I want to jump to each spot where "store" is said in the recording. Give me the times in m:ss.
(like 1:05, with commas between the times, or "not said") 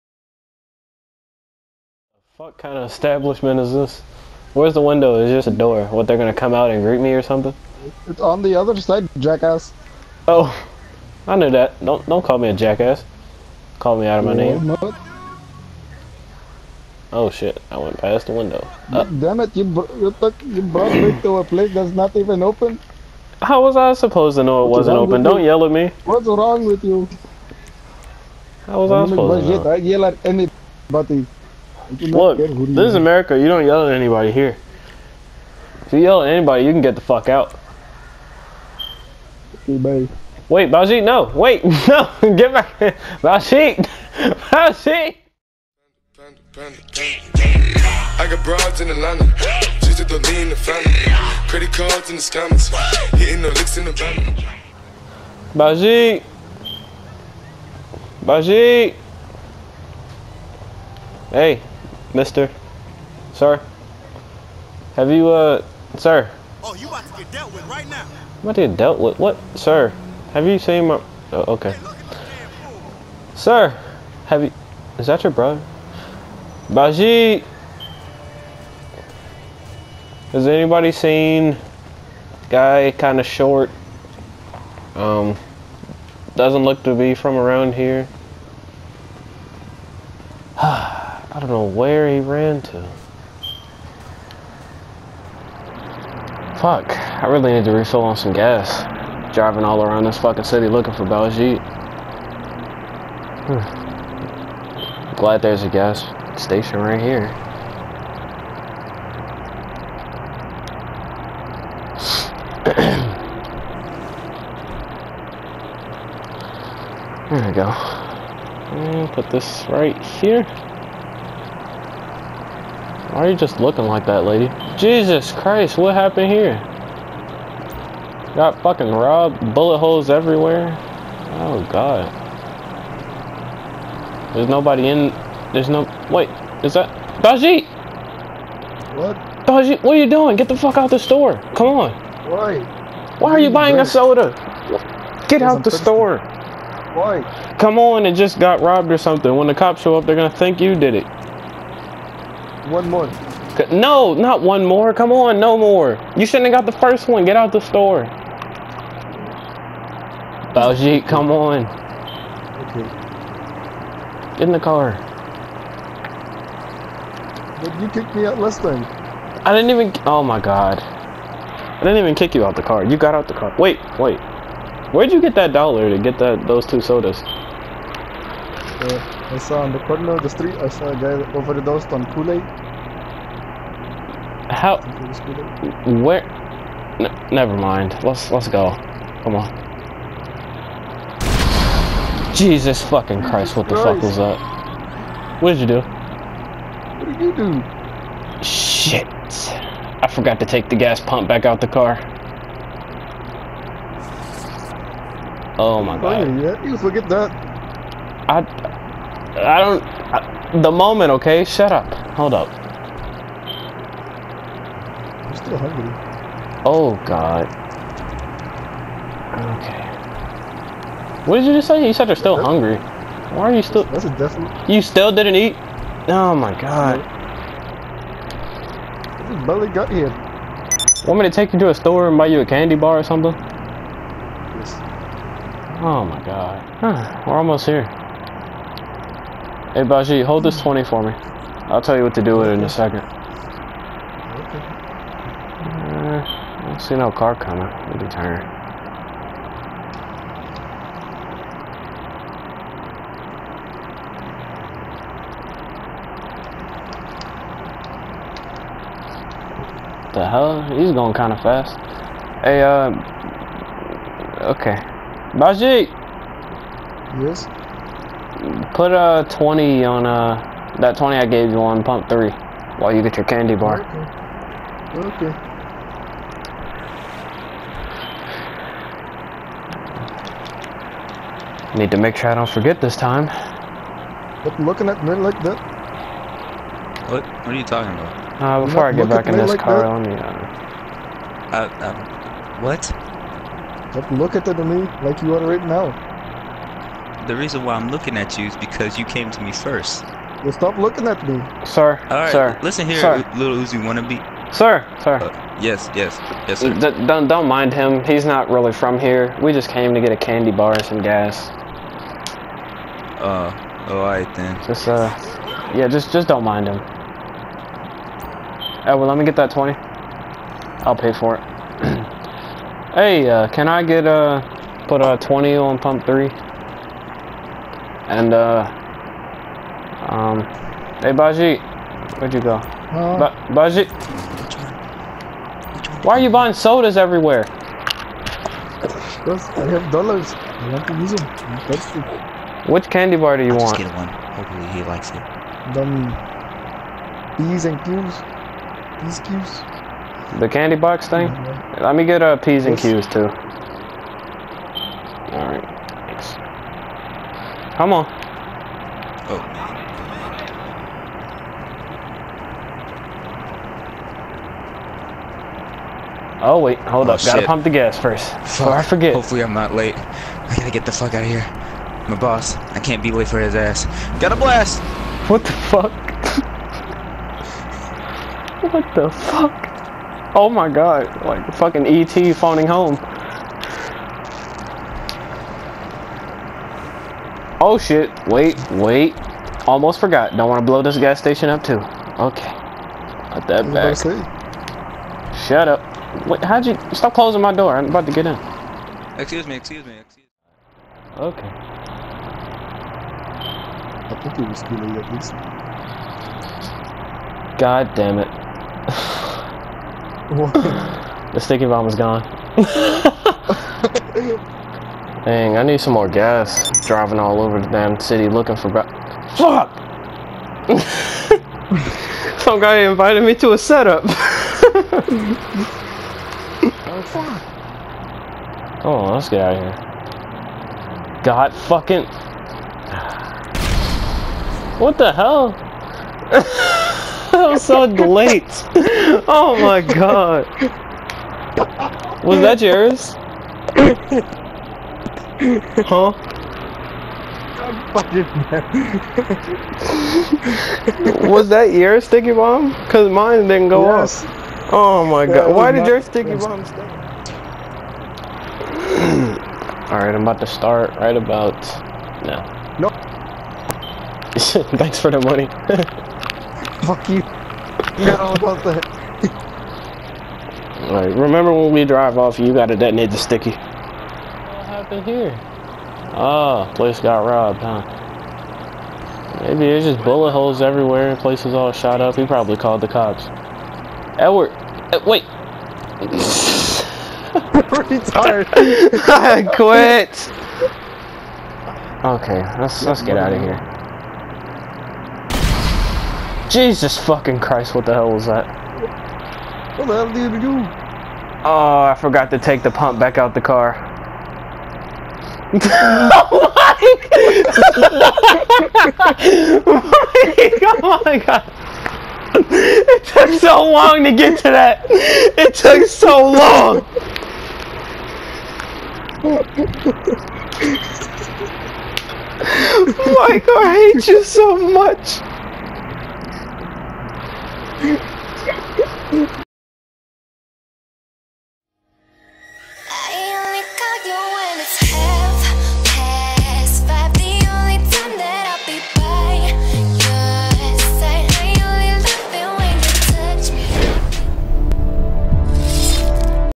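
2:20, 2:25, 2:37, 3:51.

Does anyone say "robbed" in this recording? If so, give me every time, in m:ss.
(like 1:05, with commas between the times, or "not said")
2:08, 2:28, 7:57.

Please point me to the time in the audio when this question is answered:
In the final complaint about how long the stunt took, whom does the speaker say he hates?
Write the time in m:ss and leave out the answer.
8:43.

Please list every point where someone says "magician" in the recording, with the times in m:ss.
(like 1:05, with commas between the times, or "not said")
not said.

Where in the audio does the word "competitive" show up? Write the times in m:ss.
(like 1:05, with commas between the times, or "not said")
not said.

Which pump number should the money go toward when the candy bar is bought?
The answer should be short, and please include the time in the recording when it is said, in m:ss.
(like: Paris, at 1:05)
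3, at 4:31.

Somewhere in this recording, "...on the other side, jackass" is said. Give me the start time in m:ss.
0:08.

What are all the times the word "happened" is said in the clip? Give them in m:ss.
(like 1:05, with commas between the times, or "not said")
2:05, 7:54.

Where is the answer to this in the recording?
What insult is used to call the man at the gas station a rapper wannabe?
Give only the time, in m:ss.
5:03.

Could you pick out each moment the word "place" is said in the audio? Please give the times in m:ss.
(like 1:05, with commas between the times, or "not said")
0:21, 7:56, 8:01.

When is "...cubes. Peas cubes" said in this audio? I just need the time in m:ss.
5:47.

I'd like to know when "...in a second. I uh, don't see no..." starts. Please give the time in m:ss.
4:02.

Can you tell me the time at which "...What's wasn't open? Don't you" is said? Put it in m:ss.
0:24.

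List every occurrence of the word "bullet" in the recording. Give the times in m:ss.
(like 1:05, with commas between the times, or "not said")
2:09, 8:00.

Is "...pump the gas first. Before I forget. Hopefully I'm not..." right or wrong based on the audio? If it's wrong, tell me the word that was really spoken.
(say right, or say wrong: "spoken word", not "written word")
right.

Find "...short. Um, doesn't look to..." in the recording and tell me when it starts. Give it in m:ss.
1:23.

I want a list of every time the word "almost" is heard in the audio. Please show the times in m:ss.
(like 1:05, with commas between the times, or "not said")
3:57, 6:29.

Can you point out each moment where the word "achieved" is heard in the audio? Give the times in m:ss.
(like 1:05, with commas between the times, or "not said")
not said.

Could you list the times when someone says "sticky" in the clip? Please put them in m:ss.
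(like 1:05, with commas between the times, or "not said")
6:51, 7:32, 7:36, 7:53.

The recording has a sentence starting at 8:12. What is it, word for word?
Okay, let's let's get out of here.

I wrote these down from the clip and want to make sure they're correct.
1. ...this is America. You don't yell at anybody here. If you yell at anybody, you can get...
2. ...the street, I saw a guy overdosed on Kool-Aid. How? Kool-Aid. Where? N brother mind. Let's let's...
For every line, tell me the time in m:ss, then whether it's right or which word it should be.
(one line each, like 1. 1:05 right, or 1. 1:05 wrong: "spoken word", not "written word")
1. 0:32 right
2. 3:00 wrong: "never", not "brother".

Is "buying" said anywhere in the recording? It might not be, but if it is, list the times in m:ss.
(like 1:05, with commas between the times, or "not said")
2:23, 5:36.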